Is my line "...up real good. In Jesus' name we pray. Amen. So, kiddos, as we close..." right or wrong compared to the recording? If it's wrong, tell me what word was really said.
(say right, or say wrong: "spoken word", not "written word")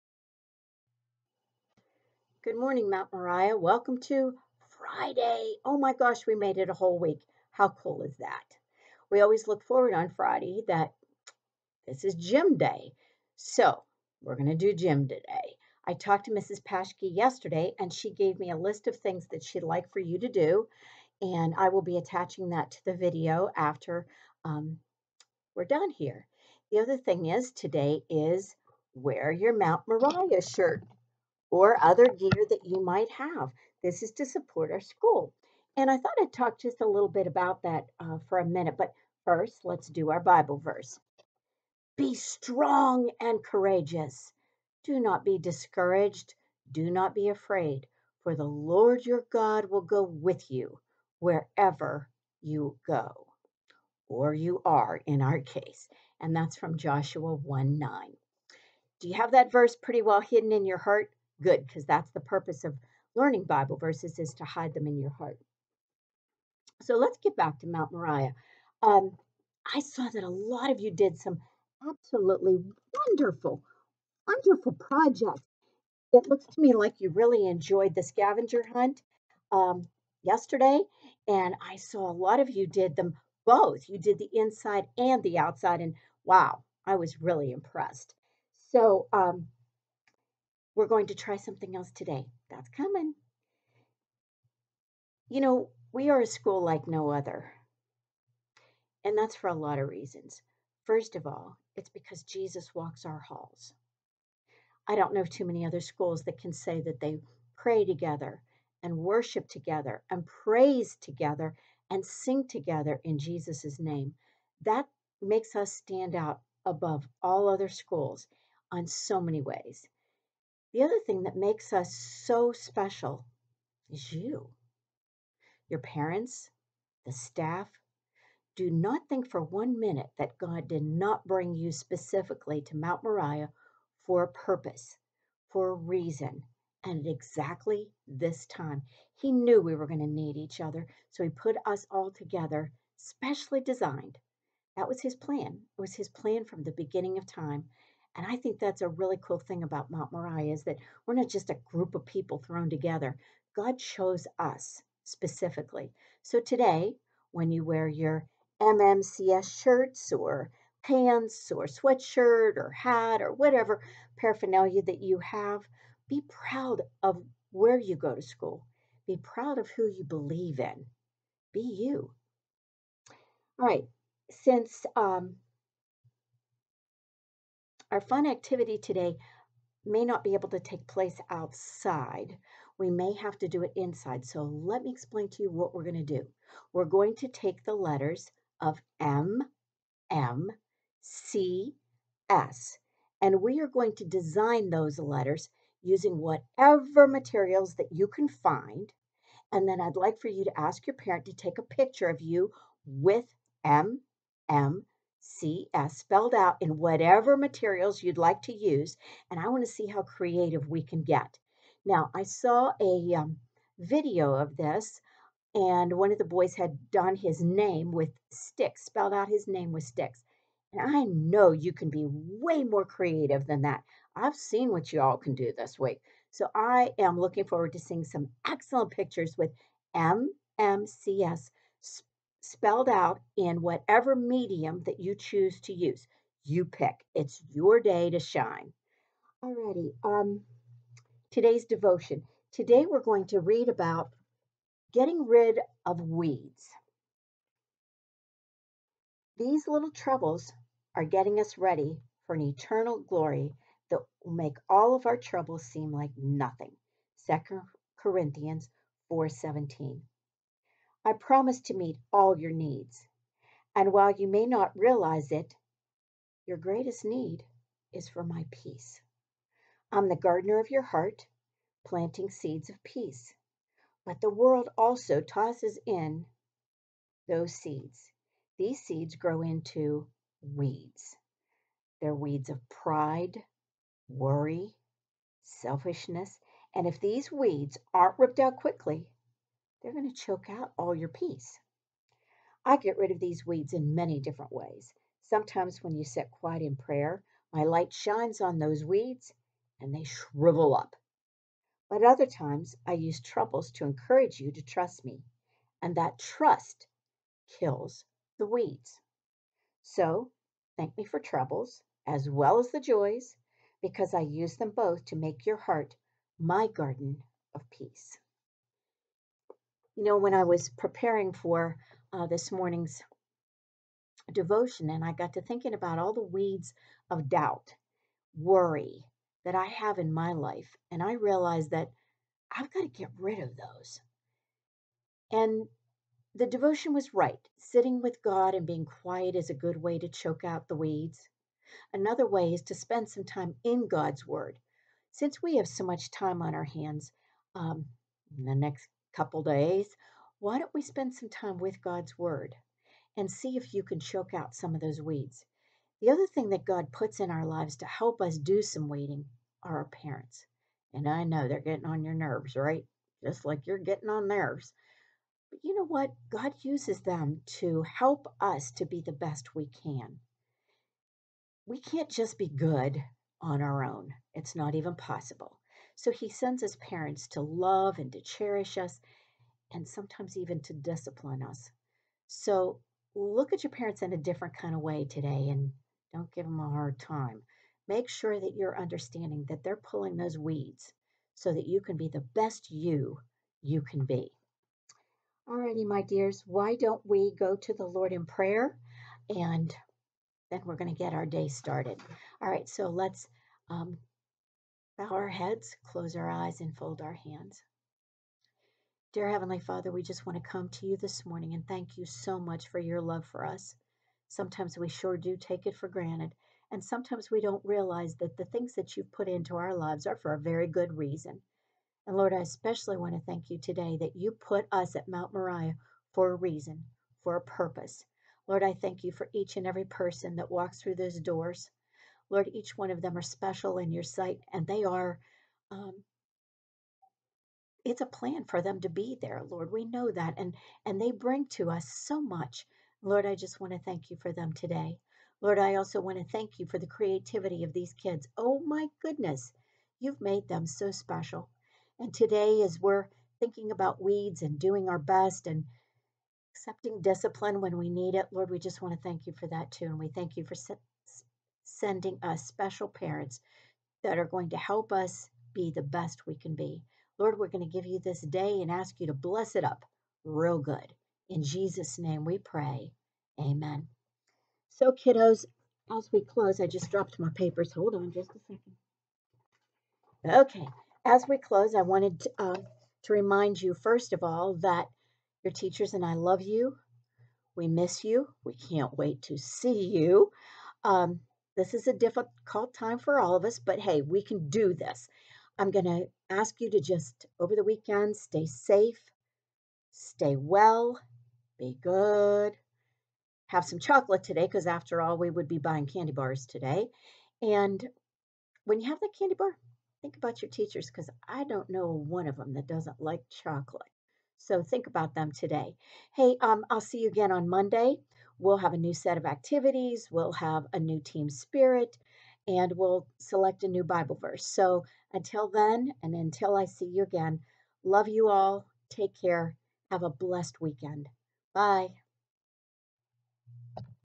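right.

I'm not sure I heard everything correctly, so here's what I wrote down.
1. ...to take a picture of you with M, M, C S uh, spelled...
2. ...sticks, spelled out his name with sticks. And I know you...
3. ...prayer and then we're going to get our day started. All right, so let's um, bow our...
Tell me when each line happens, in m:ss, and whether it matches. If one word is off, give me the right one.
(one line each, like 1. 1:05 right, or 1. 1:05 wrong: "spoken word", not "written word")
1. 3:21 right
2. 3:38 right
3. 6:38 right.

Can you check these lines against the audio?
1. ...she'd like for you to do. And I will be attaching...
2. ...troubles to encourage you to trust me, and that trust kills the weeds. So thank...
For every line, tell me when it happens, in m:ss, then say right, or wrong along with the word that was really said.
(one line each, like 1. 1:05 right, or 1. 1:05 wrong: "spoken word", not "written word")
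1. 0:19 right
2. 5:03 right.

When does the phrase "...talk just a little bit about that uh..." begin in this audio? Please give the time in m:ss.
0:36.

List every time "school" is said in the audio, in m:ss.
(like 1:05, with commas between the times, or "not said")
0:34, 1:36, 1:45, 1:57, 2:48.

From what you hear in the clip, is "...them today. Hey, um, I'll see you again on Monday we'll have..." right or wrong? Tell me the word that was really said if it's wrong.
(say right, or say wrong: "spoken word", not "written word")
right.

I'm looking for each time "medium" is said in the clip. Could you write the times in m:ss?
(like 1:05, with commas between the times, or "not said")
3:54.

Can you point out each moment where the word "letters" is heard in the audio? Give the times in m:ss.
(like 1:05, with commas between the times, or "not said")
3:07, 3:14.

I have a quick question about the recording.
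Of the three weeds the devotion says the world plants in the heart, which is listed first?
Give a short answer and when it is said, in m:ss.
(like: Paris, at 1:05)
Pride, at 4:42.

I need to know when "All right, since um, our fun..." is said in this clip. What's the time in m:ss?
2:53.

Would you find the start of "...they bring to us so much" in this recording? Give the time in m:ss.
7:21.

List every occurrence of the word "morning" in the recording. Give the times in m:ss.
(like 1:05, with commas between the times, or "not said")
0:02, 5:22, 6:51.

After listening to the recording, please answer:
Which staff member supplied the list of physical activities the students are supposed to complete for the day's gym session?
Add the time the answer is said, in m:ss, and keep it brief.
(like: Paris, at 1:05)
Mrs. Paschke, at 0:16.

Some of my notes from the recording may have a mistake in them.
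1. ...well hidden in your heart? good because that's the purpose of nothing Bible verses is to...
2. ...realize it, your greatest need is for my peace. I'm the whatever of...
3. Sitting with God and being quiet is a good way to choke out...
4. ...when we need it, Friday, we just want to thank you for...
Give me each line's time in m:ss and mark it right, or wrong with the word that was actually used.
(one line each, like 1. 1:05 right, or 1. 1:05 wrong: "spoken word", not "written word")
1. 1:00 wrong: "learning", not "nothing"
2. 4:24 wrong: "gardener", not "whatever"
3. 5:37 right
4. 7:37 wrong: "Lord", not "Friday".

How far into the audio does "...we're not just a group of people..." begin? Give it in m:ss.
2:31.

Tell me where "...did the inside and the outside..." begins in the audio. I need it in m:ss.
1:23.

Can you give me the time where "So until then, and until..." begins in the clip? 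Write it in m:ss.
8:44.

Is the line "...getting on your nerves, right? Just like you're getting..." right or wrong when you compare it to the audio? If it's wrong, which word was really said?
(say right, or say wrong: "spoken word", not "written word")
right.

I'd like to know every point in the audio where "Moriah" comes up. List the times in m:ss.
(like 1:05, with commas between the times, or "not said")
0:03, 0:29, 1:07, 2:13, 2:30, 7:05.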